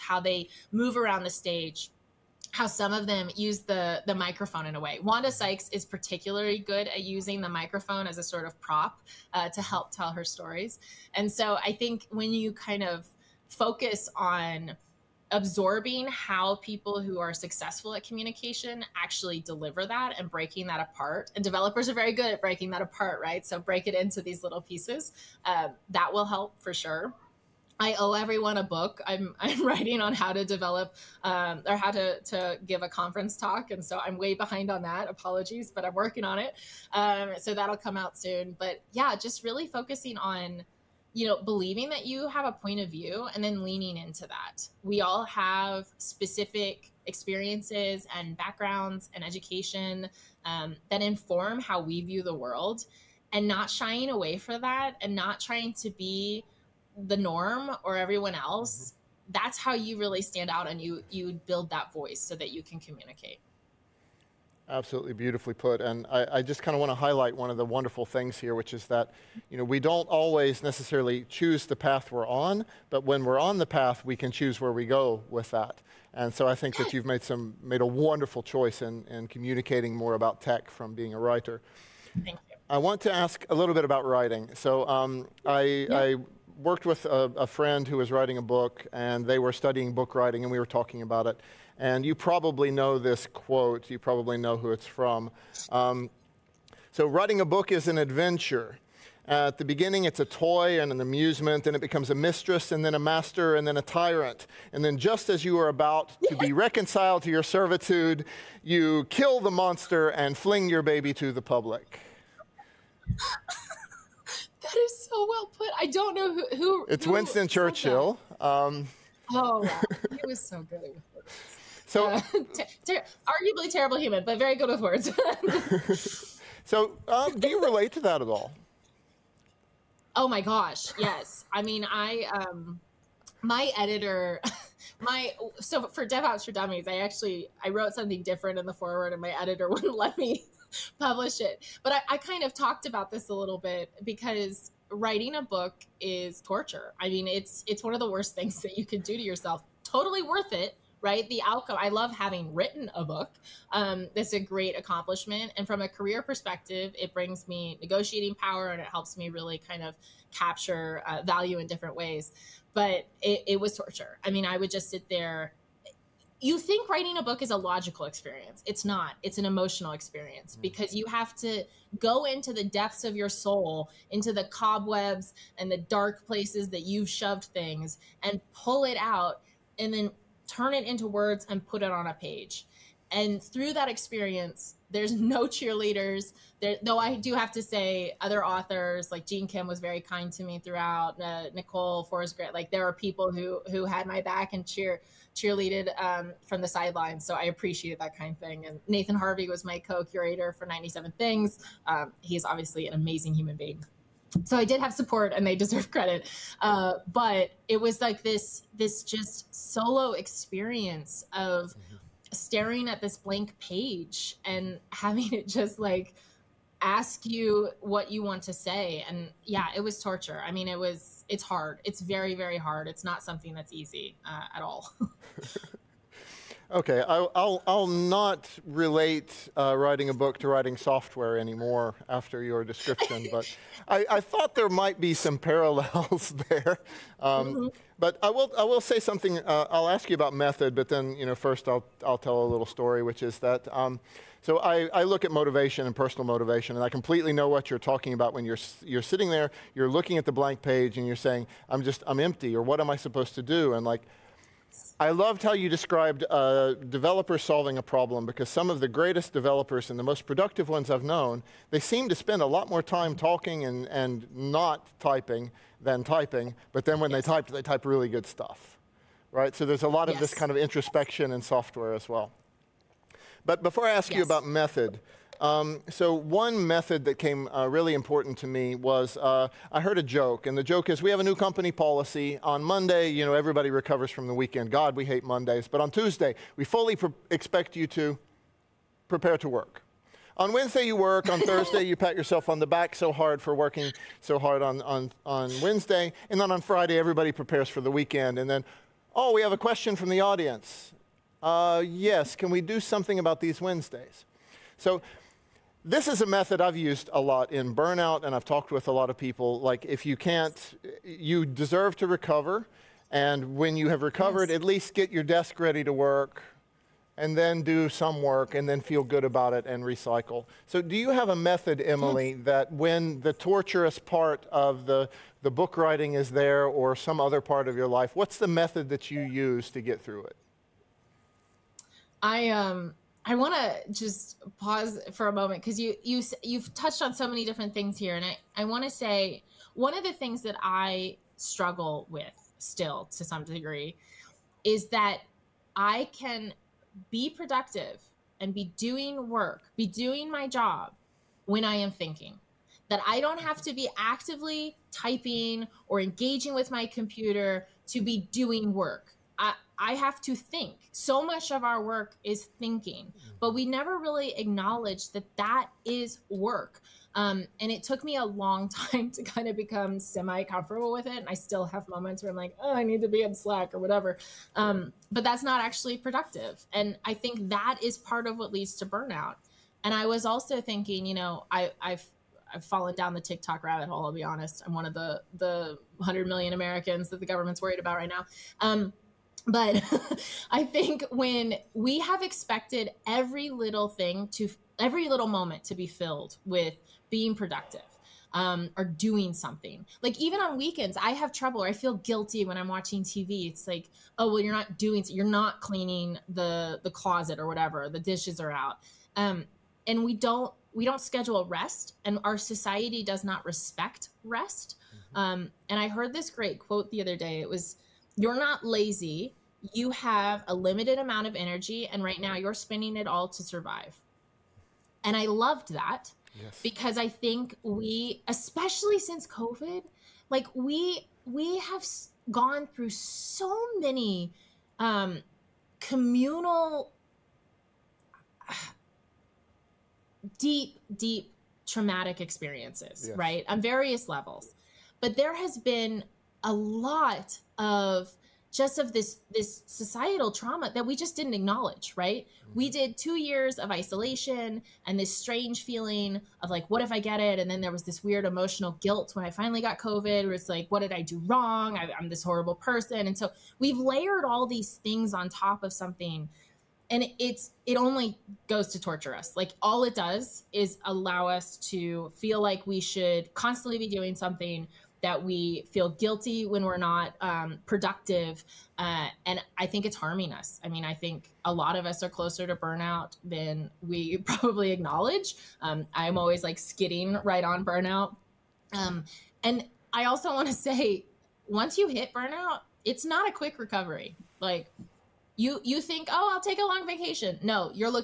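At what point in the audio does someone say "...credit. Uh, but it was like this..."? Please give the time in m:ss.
3:25.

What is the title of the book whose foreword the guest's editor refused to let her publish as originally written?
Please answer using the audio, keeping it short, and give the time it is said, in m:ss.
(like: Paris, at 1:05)
DevOps for Dummies, at 2:16.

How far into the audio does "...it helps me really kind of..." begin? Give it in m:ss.
2:38.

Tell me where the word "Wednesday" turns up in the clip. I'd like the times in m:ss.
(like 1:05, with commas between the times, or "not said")
4:50, 4:55, 5:03.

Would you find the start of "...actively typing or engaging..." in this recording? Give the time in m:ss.
5:53.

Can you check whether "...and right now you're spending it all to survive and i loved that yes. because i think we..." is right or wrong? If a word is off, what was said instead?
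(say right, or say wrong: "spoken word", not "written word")
right.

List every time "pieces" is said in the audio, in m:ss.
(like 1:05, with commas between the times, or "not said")
0:24.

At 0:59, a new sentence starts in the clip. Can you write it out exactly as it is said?
that's how you really stand out and you you build that voice so that you can communicate Absolutely beautifully put.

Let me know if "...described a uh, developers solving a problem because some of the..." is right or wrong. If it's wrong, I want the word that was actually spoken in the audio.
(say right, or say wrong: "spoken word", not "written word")
right.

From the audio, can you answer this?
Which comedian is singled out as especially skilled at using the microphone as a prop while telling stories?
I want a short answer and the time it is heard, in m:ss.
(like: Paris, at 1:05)
Wanda Sykes, at 0:05.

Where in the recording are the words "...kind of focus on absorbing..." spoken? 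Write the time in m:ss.
0:12.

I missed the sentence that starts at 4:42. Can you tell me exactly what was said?
On Monday, you know, everybody recovers from the weekend.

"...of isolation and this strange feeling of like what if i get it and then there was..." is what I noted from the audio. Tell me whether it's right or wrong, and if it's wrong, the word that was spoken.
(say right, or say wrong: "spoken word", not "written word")
right.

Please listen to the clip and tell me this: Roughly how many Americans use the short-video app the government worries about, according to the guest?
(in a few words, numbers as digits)
100 million.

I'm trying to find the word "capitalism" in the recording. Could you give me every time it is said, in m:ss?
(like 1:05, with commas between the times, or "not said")
not said.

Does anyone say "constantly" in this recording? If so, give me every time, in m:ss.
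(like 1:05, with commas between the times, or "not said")
7:53.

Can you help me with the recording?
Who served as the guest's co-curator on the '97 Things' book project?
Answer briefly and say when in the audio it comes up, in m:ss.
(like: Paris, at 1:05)
Nathan Harvey, at 3:18.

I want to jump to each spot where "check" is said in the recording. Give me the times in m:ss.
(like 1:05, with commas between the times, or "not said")
not said.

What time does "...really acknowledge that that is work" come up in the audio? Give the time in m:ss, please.
6:03.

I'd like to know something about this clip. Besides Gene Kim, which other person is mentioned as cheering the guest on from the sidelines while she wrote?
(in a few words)
Nicole Forsgren.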